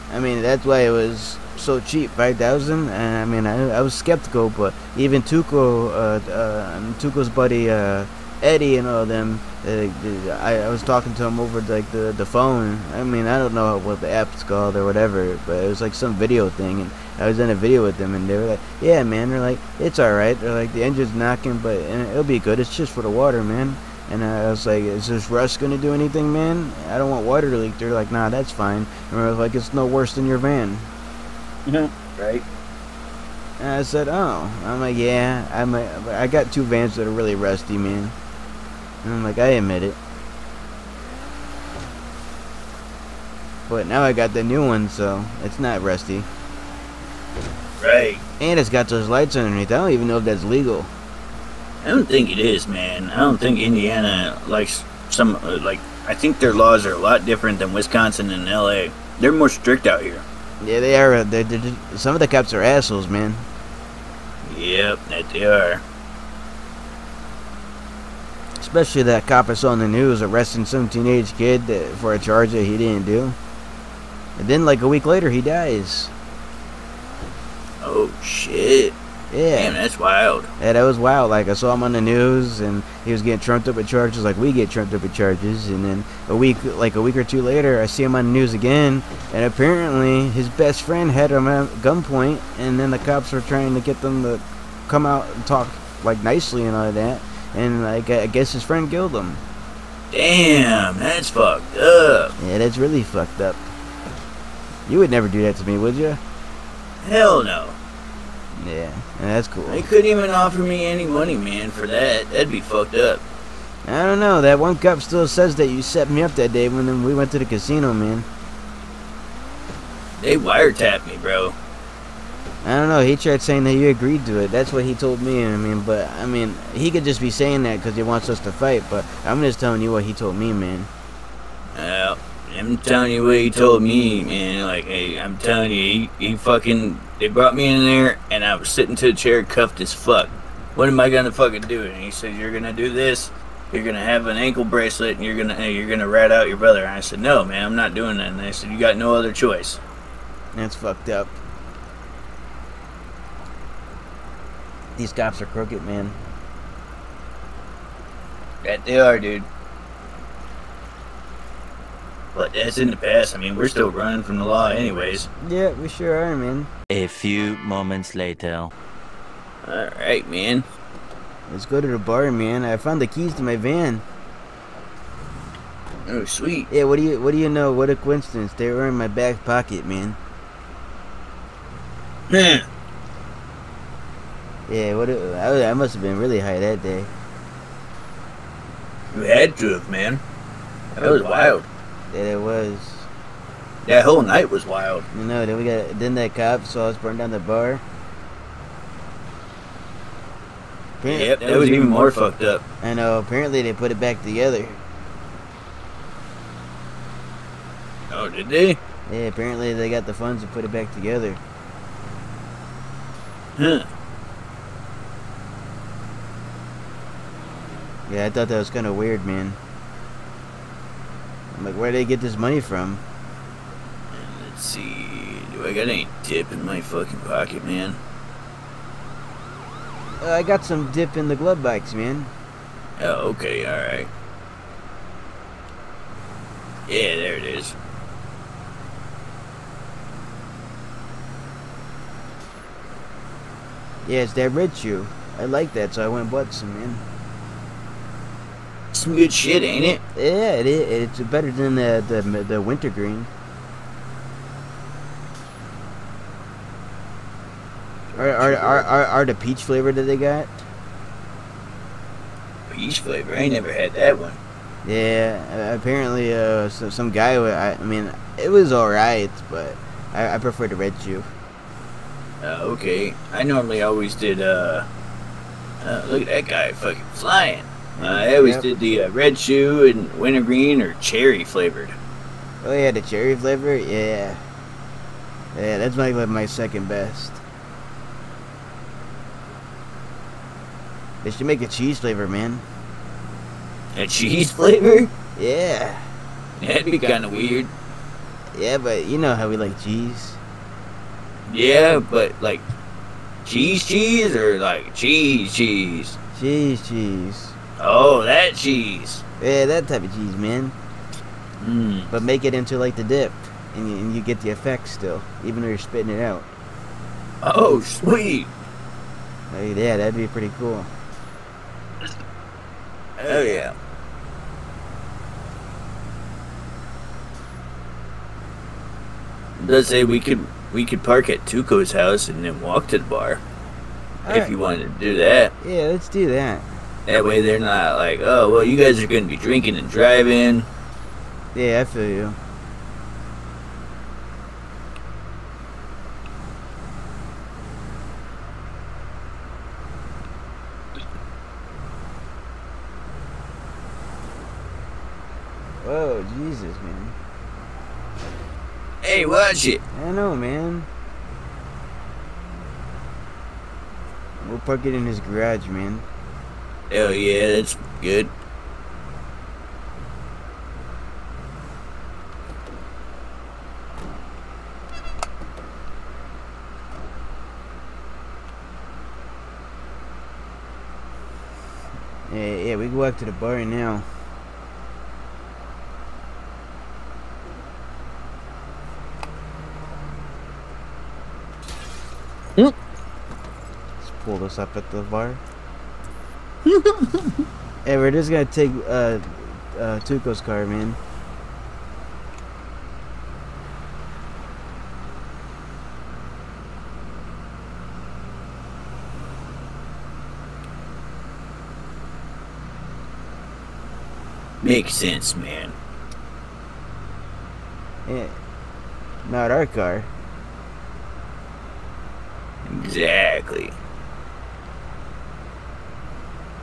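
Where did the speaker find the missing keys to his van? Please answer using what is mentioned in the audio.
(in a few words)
back pocket.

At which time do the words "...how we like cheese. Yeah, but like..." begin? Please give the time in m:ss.
4:59.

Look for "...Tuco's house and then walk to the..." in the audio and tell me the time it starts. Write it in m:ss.
5:31.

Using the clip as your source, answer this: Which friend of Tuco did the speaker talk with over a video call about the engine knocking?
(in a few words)
Eddie.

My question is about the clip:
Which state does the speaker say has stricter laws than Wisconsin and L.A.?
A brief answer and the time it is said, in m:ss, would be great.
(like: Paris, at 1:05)
Indiana, at 0:53.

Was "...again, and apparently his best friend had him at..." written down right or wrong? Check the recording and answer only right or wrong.
right.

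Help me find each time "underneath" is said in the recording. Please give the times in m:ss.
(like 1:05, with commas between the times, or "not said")
0:49.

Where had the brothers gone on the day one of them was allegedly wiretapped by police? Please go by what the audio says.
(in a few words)
the casino.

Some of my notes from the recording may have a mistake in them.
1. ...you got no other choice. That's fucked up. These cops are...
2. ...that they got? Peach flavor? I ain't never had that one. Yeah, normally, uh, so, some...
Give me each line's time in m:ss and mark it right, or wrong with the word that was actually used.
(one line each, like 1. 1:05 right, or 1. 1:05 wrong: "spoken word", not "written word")
1. 2:28 right
2. 4:19 wrong: "apparently", not "normally".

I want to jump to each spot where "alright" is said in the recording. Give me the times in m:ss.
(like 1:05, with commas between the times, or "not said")
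2:49, 3:53.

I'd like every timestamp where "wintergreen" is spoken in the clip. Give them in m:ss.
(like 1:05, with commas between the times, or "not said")
4:12, 4:40.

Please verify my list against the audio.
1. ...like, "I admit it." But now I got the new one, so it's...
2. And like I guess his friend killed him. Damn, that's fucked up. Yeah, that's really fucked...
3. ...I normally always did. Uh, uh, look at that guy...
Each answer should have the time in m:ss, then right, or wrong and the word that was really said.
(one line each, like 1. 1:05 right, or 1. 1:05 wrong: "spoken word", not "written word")
1. 0:39 right
2. 1:37 right
3. 4:33 right.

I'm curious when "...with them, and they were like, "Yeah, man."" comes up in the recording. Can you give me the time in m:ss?
0:17.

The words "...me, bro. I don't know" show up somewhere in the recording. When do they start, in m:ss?
2:01.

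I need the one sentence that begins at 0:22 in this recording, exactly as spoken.
It's just for the water, man." And I was like, "Is this rust gonna do anything, man?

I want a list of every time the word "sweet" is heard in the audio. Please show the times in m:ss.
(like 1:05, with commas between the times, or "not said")
2:56, 5:17.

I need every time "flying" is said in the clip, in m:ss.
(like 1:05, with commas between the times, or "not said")
4:37.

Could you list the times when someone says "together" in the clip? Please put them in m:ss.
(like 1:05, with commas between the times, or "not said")
3:24, 3:30.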